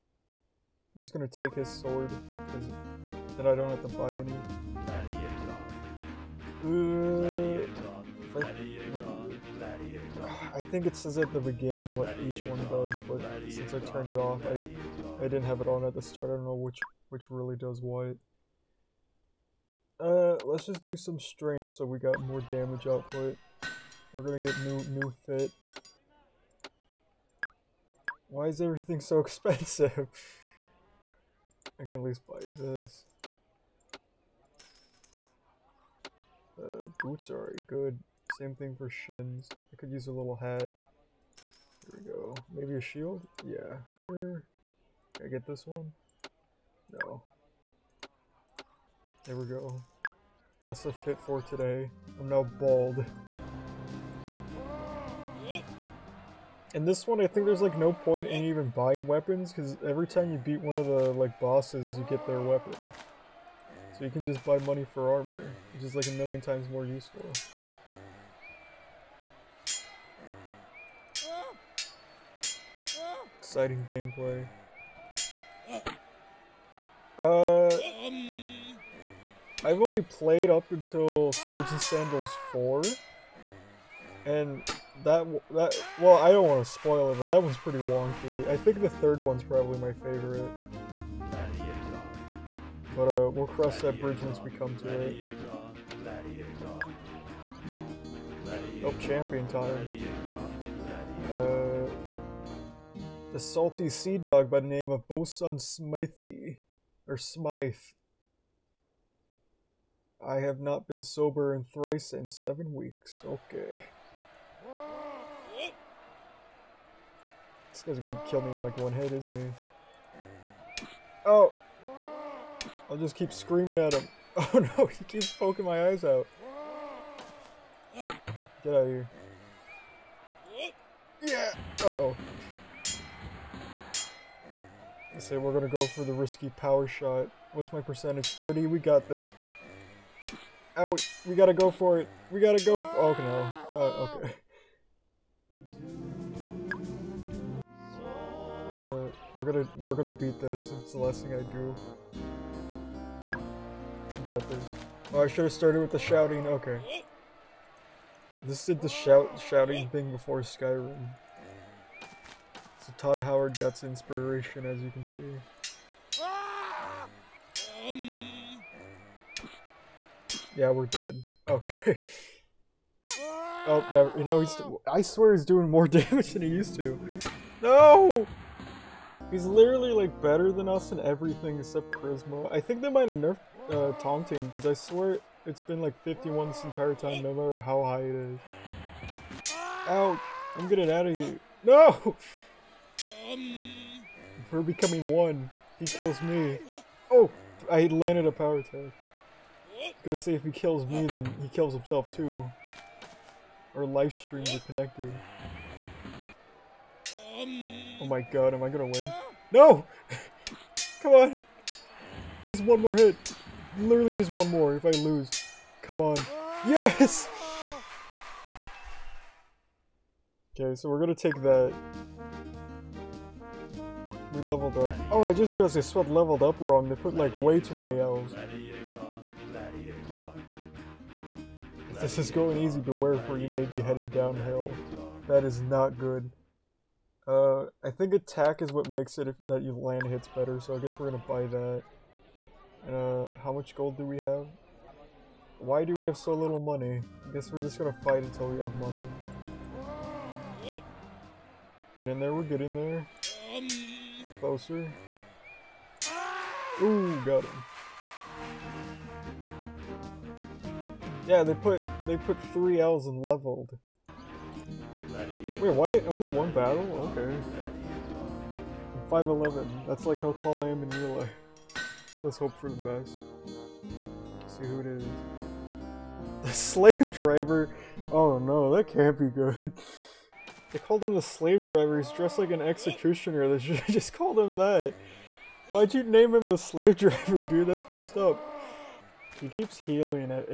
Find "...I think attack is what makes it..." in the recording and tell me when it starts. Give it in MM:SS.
03:57.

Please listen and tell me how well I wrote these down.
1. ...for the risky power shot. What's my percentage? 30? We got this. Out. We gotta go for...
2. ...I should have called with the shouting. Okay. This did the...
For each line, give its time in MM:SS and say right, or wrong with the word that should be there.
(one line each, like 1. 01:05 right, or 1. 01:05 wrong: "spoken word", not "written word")
1. 02:15 right
2. 02:35 wrong: "started", not "called".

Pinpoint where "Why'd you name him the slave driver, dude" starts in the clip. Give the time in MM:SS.
04:45.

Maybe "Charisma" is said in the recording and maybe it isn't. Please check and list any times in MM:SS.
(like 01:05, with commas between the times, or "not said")
03:01.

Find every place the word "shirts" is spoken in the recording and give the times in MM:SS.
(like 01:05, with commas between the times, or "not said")
not said.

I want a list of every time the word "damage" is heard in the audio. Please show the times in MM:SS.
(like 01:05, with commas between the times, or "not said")
00:22, 02:55.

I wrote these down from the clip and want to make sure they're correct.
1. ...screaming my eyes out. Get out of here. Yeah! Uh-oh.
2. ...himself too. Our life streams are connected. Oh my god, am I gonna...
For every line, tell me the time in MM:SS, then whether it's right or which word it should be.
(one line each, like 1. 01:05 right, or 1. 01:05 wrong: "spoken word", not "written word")
1. 02:05 wrong: "poking", not "screaming"
2. 03:21 right.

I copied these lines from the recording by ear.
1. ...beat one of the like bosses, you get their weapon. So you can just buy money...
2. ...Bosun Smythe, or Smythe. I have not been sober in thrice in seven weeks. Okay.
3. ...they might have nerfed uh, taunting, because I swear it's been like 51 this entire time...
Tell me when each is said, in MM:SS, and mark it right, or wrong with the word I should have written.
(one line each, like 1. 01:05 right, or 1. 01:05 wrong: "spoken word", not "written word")
1. 01:00 right
2. 01:45 right
3. 03:02 right.